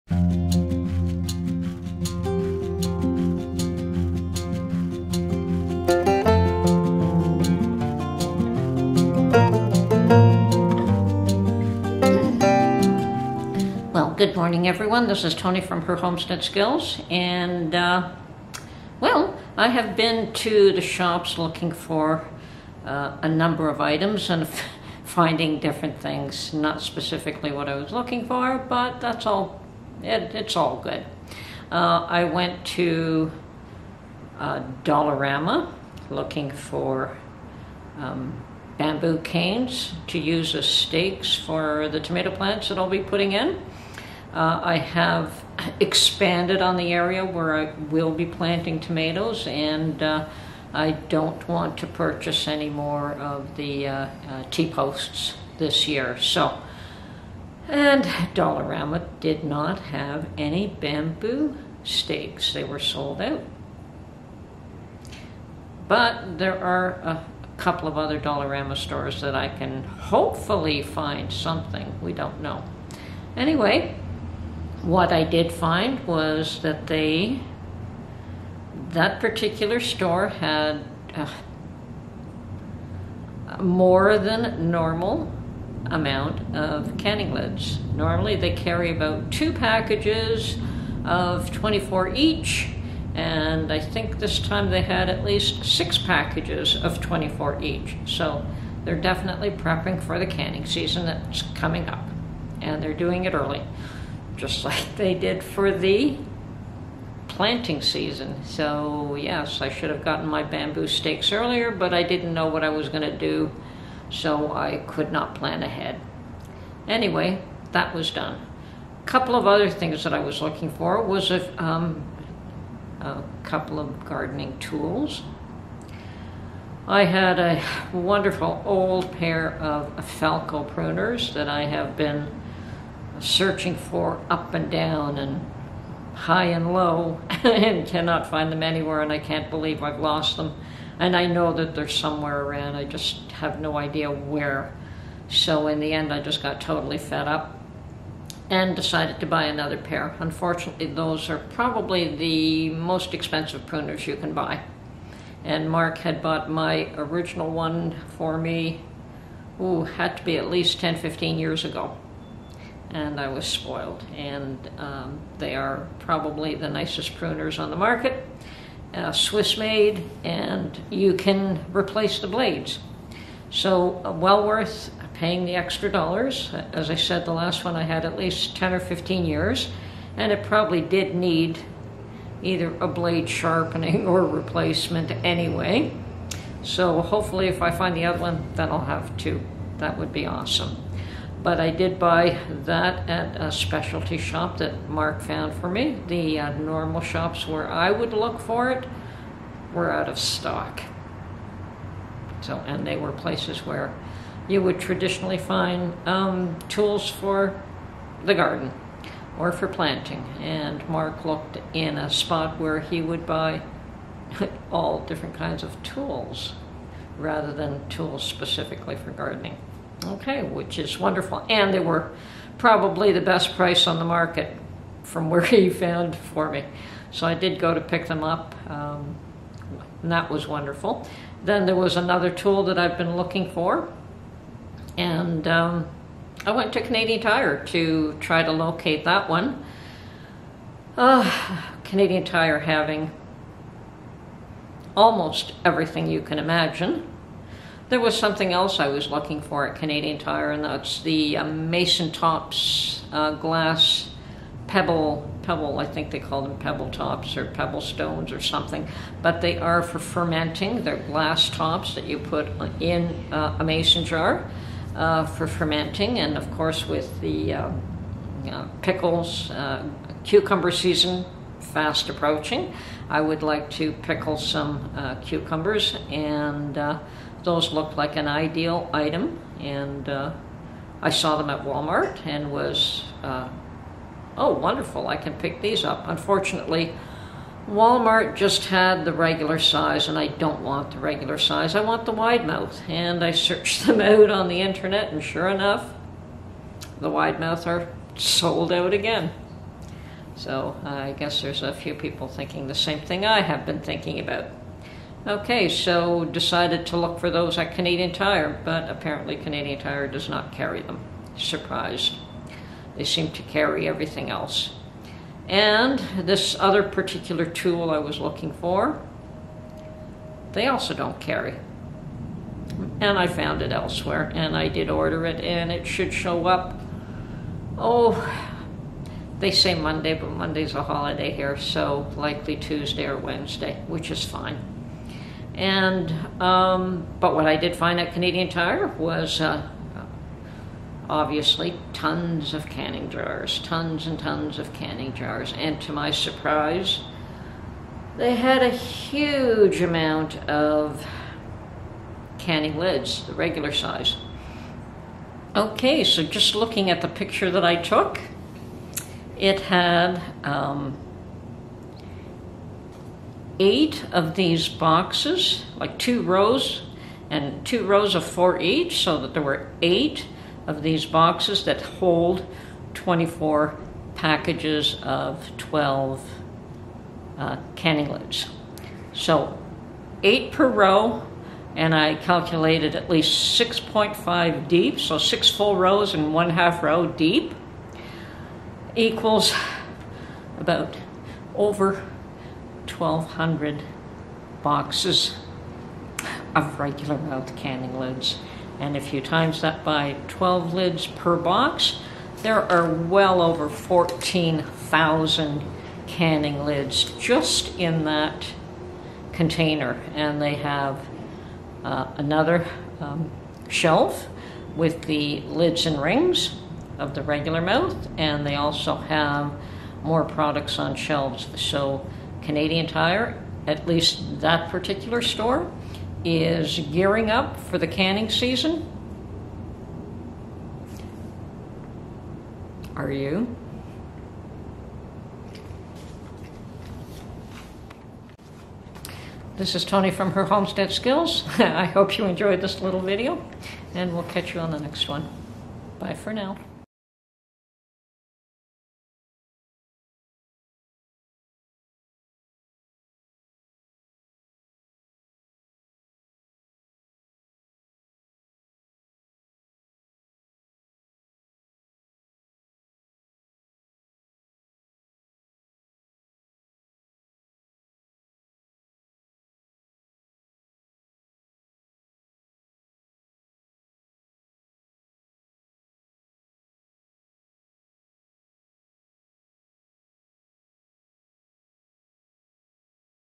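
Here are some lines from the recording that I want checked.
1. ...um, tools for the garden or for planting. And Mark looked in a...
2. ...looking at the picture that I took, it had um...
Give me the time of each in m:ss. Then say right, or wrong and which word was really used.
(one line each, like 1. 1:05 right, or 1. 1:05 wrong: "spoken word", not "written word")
1. 3:26 right
2. 5:56 right.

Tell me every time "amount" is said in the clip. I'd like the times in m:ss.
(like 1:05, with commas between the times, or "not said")
1:25, 5:49.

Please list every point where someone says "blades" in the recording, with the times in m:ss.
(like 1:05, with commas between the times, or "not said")
2:52, 3:02.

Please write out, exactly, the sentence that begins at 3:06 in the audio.
So, hopefully, if I find the other one, then I'll have two.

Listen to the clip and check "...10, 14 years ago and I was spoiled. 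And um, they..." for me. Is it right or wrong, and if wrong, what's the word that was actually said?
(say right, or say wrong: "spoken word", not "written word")
wrong: "15", not "14".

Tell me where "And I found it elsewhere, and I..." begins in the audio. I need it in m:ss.
5:22.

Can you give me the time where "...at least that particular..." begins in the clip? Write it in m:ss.
7:03.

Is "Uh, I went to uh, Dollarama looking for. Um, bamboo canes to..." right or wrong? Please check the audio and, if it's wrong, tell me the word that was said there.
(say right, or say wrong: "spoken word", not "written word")
right.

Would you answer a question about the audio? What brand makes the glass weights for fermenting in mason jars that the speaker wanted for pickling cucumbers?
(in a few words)
Masontops.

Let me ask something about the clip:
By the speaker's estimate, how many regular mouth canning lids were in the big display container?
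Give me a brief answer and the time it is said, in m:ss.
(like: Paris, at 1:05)
14,000, at 6:43.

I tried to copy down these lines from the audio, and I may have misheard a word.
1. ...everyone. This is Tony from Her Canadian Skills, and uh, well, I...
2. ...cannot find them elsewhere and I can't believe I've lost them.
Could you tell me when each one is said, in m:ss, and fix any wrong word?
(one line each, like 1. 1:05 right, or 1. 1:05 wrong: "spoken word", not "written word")
1. 0:14 wrong: "Homestead", not "Canadian"
2. 2:17 wrong: "anywhere", not "elsewhere".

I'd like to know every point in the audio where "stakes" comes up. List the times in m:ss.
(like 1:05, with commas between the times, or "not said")
0:40, 1:01, 1:50.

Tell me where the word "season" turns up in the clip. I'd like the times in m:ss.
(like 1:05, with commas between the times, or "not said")
1:40, 1:47, 4:30, 7:08.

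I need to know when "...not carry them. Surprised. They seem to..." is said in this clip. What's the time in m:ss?
5:10.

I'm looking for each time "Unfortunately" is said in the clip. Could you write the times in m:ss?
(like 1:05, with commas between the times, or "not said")
2:30, 4:46.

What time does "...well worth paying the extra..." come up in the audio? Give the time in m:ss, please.
2:54.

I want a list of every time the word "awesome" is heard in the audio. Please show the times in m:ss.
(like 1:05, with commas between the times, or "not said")
3:10.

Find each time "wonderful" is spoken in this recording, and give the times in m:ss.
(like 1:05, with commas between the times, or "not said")
2:07, 3:40, 3:50, 4:44.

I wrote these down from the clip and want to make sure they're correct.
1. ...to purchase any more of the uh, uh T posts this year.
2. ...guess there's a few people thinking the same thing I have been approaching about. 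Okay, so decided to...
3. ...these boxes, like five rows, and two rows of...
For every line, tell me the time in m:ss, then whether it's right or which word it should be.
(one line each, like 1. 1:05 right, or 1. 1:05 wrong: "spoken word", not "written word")
1. 0:51 right
2. 5:01 wrong: "thinking", not "approaching"
3. 6:04 wrong: "two", not "five".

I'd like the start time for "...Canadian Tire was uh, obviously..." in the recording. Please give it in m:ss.
5:38.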